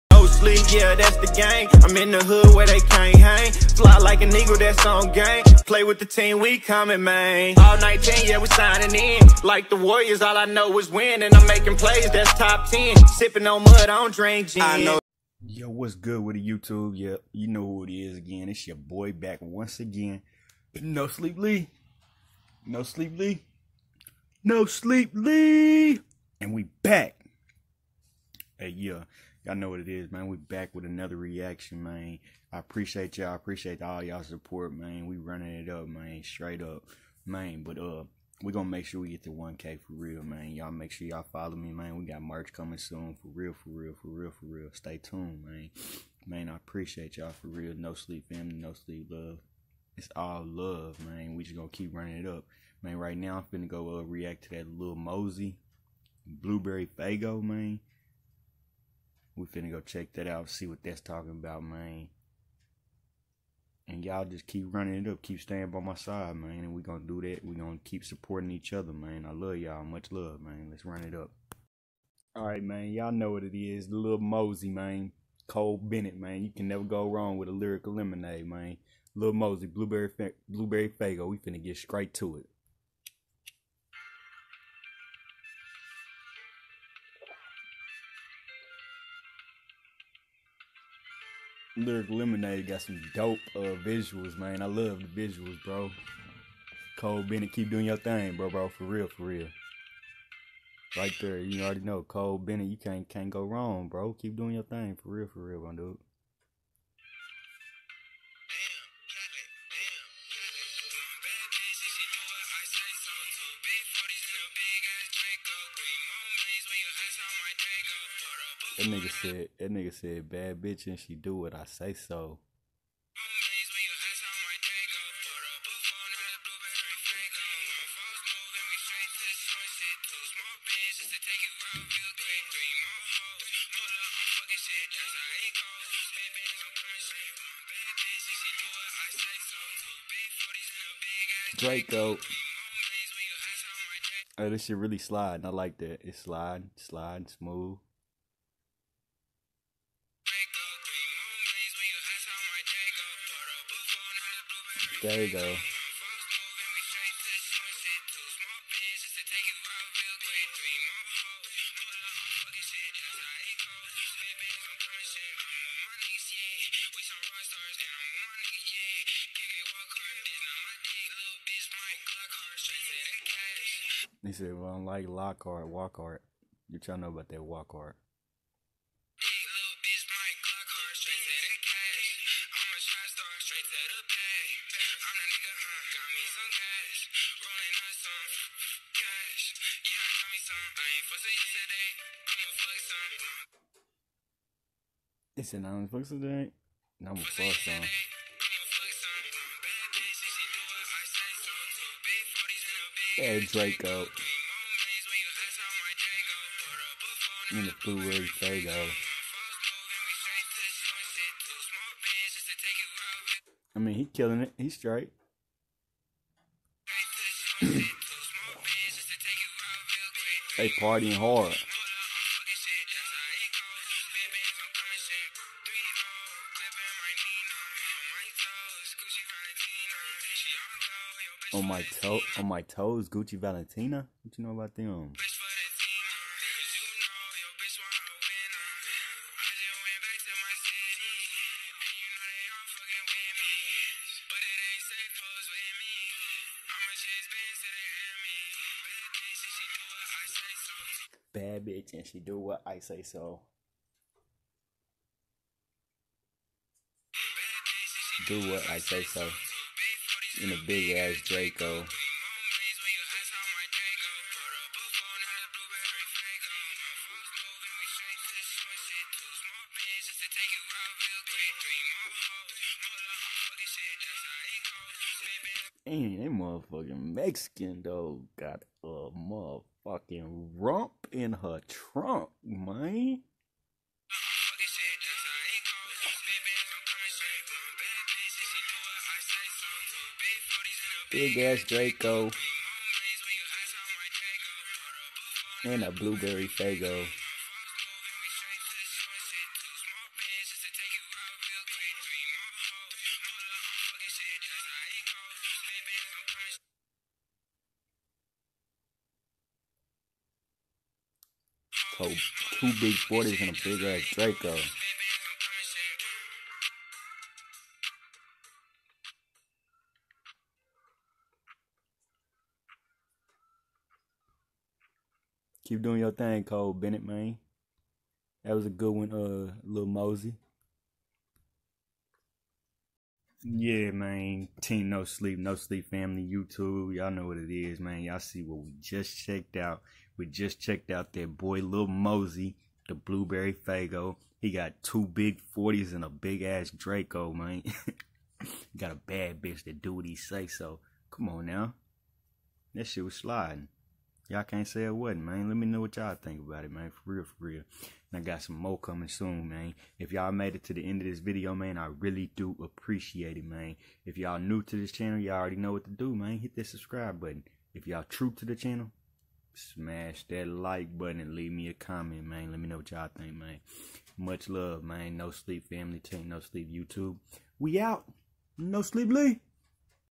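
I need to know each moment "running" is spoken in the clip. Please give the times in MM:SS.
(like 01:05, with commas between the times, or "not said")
00:35, 00:51, 01:04.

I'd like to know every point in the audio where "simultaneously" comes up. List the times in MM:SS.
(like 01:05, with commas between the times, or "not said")
not said.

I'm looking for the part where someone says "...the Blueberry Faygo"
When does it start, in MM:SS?
05:42.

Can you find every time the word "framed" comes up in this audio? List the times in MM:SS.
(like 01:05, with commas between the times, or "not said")
not said.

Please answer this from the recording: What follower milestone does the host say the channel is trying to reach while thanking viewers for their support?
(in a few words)
1K.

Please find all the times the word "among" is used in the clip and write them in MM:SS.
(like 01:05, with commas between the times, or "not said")
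not said.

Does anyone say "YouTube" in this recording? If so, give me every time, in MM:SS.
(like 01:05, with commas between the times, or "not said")
00:16, 05:36, 06:16.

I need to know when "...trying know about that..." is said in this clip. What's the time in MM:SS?
02:56.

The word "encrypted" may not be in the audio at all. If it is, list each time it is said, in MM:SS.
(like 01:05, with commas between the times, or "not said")
not said.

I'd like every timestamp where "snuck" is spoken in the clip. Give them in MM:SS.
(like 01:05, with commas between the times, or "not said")
not said.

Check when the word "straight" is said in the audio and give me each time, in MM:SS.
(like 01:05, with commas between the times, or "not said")
00:36, 01:21, 03:03.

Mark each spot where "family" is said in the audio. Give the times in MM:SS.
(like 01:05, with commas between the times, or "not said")
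00:48, 05:35, 06:15.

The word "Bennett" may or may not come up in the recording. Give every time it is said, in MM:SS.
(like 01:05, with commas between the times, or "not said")
01:15, 01:37, 01:42, 05:26.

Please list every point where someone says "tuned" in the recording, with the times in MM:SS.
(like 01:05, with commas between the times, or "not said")
00:44.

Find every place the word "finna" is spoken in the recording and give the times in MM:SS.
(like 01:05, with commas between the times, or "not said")
00:53, 00:59, 01:21.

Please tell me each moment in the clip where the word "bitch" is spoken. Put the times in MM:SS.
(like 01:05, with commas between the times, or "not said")
02:00, 04:11, 05:49.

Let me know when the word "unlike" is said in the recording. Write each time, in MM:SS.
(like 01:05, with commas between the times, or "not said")
02:54.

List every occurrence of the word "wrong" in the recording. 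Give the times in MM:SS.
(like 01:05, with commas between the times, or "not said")
01:17, 01:43.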